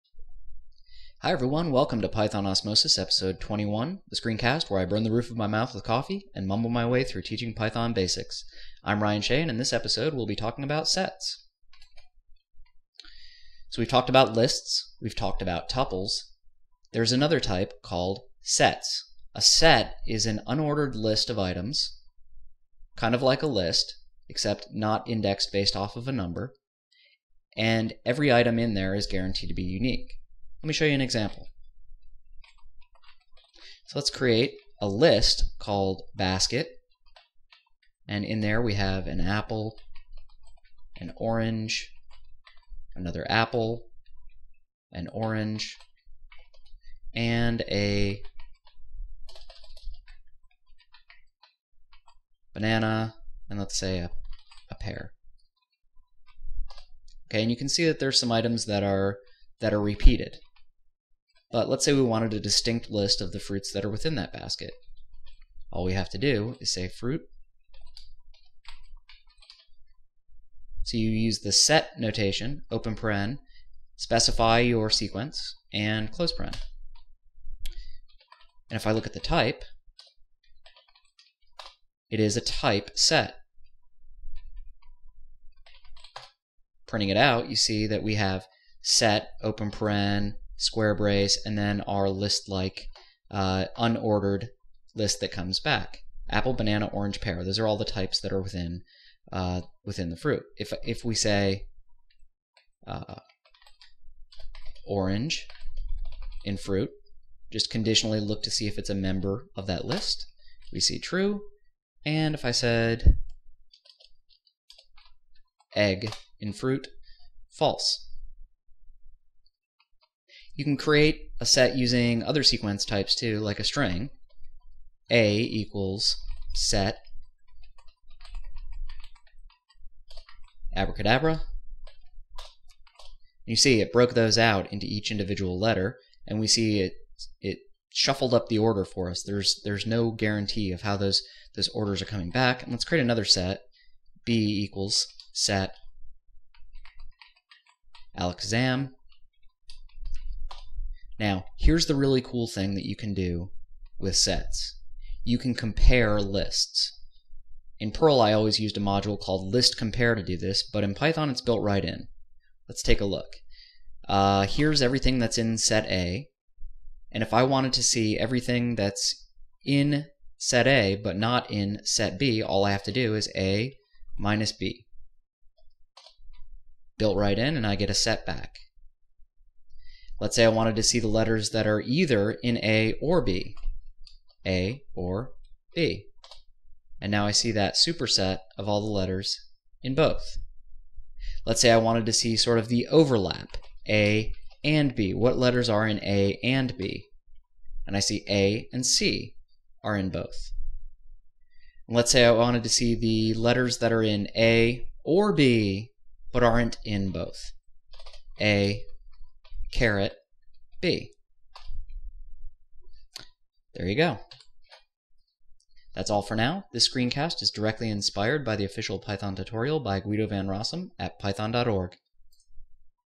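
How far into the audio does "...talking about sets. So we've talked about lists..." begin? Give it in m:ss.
0:10.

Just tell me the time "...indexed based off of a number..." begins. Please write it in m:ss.
0:25.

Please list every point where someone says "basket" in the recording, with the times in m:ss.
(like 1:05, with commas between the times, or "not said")
0:36, 1:04.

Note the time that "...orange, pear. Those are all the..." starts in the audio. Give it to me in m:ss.
1:36.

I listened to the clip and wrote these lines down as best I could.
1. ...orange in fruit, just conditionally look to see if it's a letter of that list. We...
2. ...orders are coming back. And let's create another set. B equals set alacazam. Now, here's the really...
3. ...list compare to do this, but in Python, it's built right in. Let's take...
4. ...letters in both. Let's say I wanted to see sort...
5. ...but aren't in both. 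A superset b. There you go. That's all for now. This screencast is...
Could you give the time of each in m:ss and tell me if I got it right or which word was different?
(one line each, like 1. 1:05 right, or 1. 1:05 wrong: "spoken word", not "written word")
1. 1:44 wrong: "member", not "letter"
2. 2:21 right
3. 2:39 right
4. 3:08 right
5. 3:26 wrong: "caret", not "superset".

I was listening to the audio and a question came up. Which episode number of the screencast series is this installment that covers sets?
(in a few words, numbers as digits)
21.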